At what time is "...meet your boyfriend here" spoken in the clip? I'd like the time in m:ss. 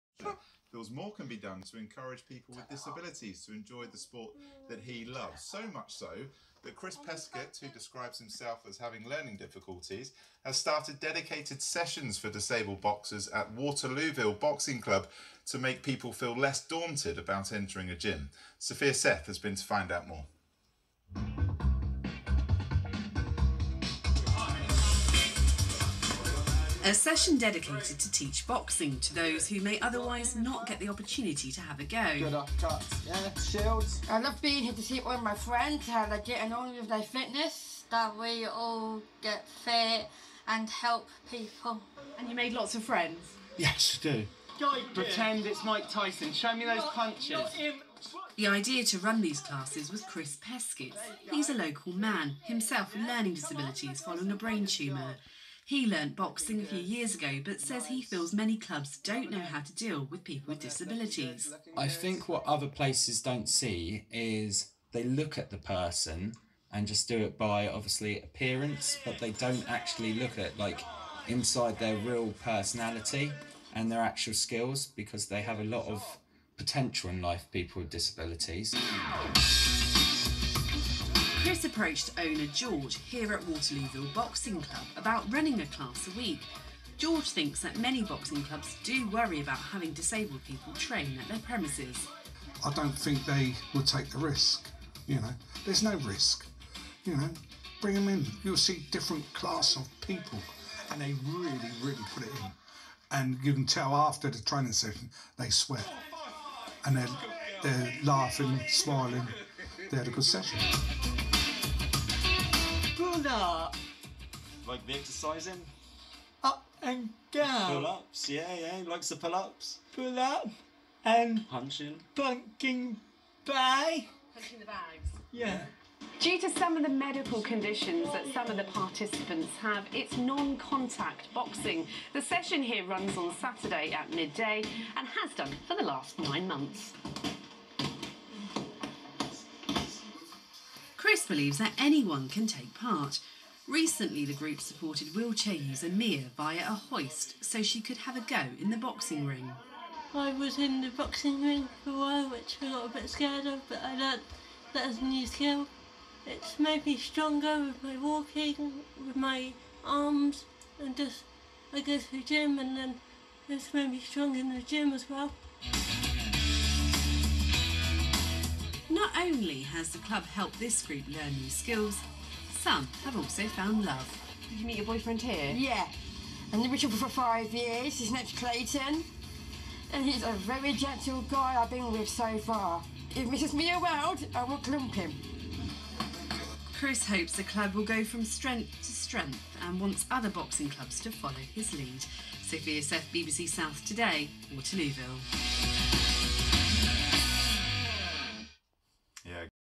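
2:54.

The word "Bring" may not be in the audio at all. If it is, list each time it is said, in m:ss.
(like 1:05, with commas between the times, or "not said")
1:37.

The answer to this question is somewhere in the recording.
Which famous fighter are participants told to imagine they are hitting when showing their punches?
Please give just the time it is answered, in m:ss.
0:45.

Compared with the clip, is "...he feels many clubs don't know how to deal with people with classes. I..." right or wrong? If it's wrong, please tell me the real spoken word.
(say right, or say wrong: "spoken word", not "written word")
wrong: "disabilities", not "classes".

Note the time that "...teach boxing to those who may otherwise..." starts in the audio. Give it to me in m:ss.
0:28.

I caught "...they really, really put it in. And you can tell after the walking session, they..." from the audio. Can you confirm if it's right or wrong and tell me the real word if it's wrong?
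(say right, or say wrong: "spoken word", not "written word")
wrong: "training", not "walking".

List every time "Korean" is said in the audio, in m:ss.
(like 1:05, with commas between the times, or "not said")
not said.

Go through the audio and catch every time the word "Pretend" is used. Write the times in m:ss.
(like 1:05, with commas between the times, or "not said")
0:44.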